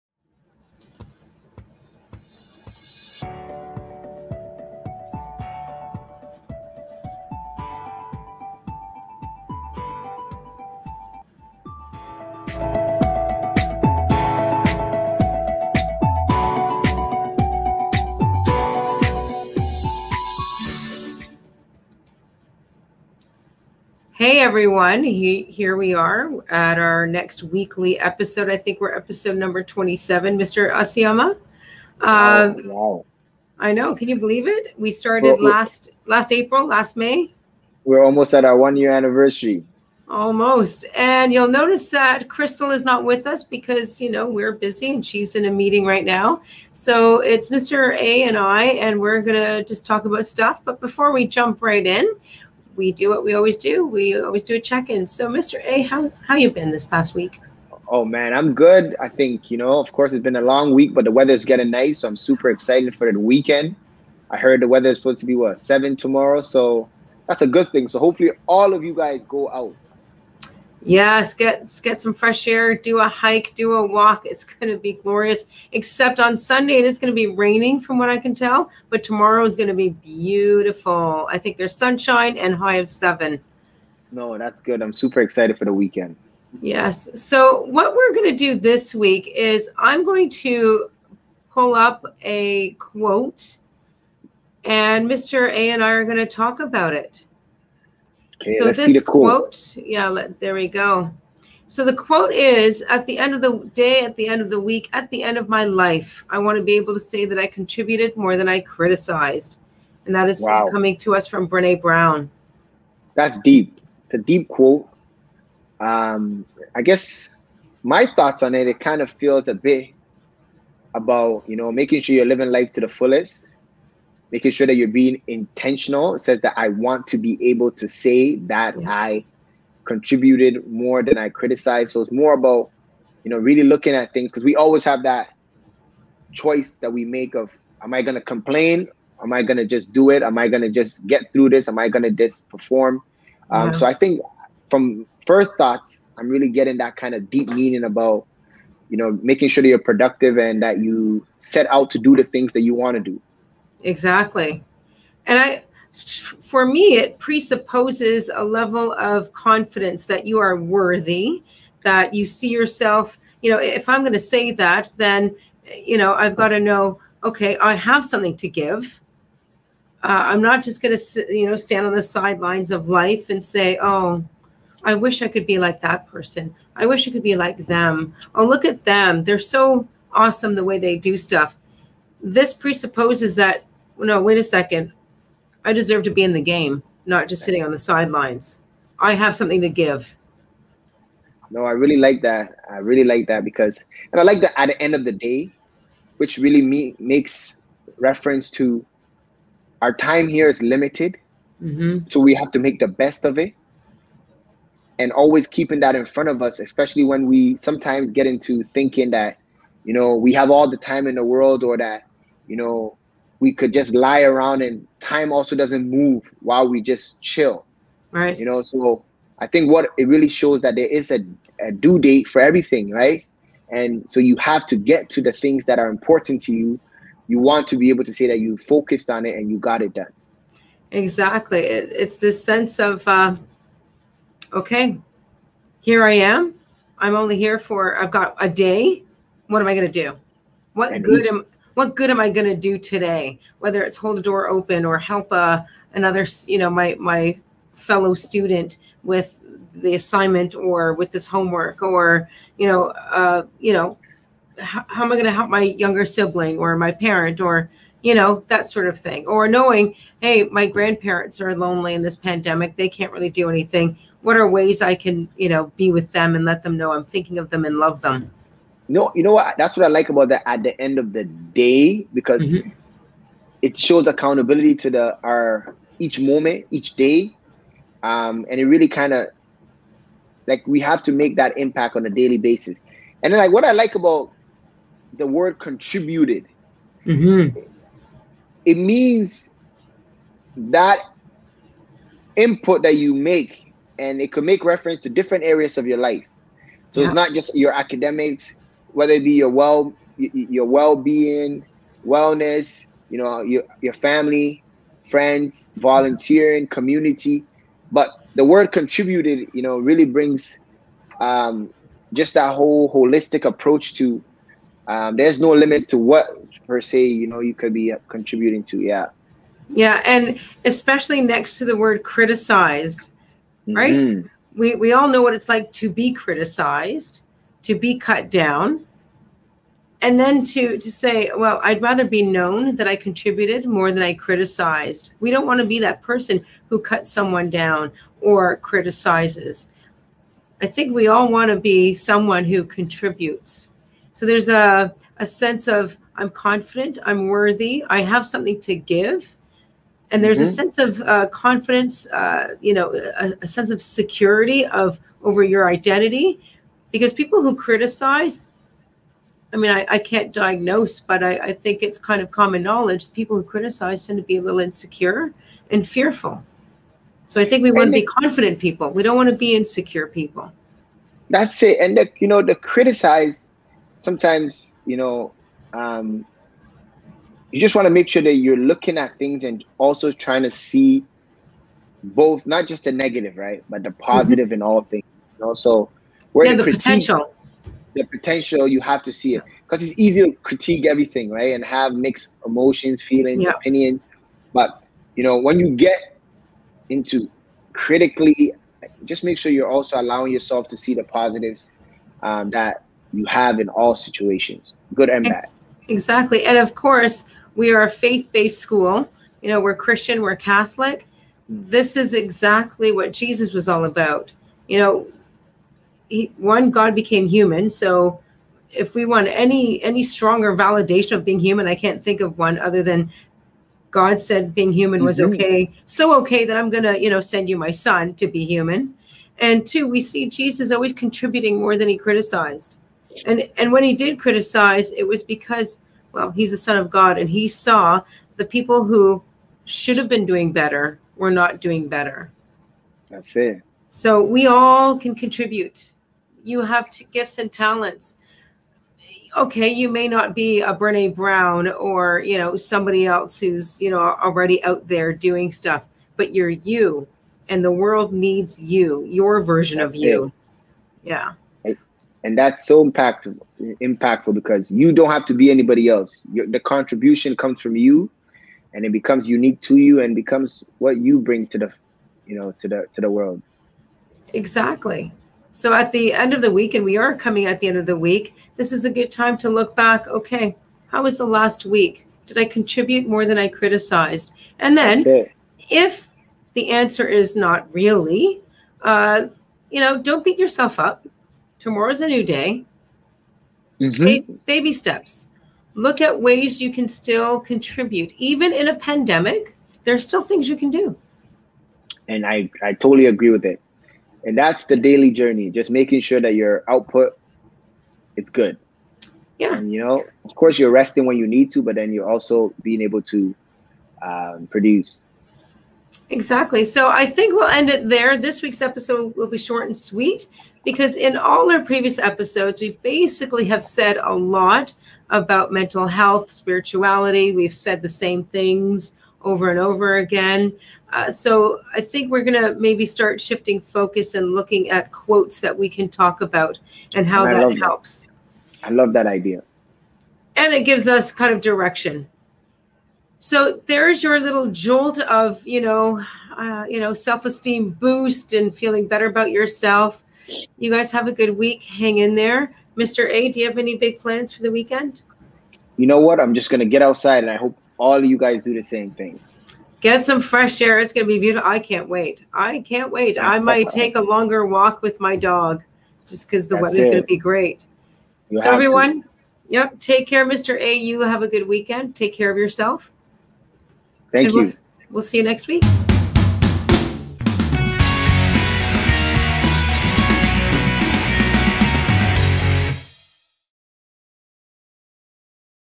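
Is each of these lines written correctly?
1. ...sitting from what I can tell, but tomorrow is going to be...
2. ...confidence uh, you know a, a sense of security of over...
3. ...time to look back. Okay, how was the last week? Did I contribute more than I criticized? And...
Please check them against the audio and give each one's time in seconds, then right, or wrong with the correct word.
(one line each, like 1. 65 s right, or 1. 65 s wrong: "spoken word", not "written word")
1. 77 s wrong: "raining", not "sitting"
2. 351 s right
3. 479 s right.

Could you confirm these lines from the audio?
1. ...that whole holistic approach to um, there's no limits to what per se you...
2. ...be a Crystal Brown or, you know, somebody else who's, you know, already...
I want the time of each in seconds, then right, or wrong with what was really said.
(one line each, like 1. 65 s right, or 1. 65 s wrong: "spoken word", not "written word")
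1. 312 s right
2. 450 s wrong: "Brene", not "Crystal".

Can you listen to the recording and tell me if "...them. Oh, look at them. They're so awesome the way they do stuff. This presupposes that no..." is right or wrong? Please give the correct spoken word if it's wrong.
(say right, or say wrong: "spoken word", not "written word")
right.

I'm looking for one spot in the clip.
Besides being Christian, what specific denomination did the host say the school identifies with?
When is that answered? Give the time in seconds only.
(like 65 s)
410 s.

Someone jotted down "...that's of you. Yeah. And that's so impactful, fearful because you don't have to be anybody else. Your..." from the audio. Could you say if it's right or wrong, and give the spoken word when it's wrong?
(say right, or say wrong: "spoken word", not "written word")
wrong: "impactful", not "fearful".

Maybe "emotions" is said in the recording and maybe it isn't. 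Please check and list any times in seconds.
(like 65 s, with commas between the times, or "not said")
392 s.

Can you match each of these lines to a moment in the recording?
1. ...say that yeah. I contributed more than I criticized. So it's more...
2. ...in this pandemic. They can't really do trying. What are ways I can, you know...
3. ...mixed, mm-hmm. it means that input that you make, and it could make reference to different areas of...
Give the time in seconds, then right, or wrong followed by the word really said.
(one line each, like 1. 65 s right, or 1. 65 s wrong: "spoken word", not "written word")
1. 127 s right
2. 261 s wrong: "anything", not "trying"
3. 285 s wrong: "contributed", not "mixed".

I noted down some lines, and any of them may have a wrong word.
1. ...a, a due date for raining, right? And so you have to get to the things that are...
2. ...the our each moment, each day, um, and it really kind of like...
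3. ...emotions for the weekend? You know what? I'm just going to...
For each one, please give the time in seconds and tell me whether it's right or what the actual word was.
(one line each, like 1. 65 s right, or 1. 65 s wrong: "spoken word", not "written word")
1. 221 s wrong: "everything", not "raining"
2. 274 s right
3. 553 s wrong: "plans", not "emotions".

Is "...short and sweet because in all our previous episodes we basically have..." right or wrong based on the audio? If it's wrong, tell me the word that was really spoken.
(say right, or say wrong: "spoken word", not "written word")
right.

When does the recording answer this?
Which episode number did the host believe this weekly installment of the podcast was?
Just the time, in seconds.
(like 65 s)
29 s.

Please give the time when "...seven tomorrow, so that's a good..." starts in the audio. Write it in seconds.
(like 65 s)
65 s.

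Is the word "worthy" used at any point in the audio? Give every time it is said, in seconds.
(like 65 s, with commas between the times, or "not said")
160 s, 347 s.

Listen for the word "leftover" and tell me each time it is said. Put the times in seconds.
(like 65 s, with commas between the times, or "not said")
not said.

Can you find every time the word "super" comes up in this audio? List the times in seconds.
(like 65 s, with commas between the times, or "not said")
62 s, 84 s.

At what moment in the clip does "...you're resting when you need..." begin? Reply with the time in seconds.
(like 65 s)
510 s.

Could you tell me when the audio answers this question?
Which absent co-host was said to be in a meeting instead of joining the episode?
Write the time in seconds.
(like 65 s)
42 s.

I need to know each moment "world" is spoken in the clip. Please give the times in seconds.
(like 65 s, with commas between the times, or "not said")
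211 s, 457 s, 473 s.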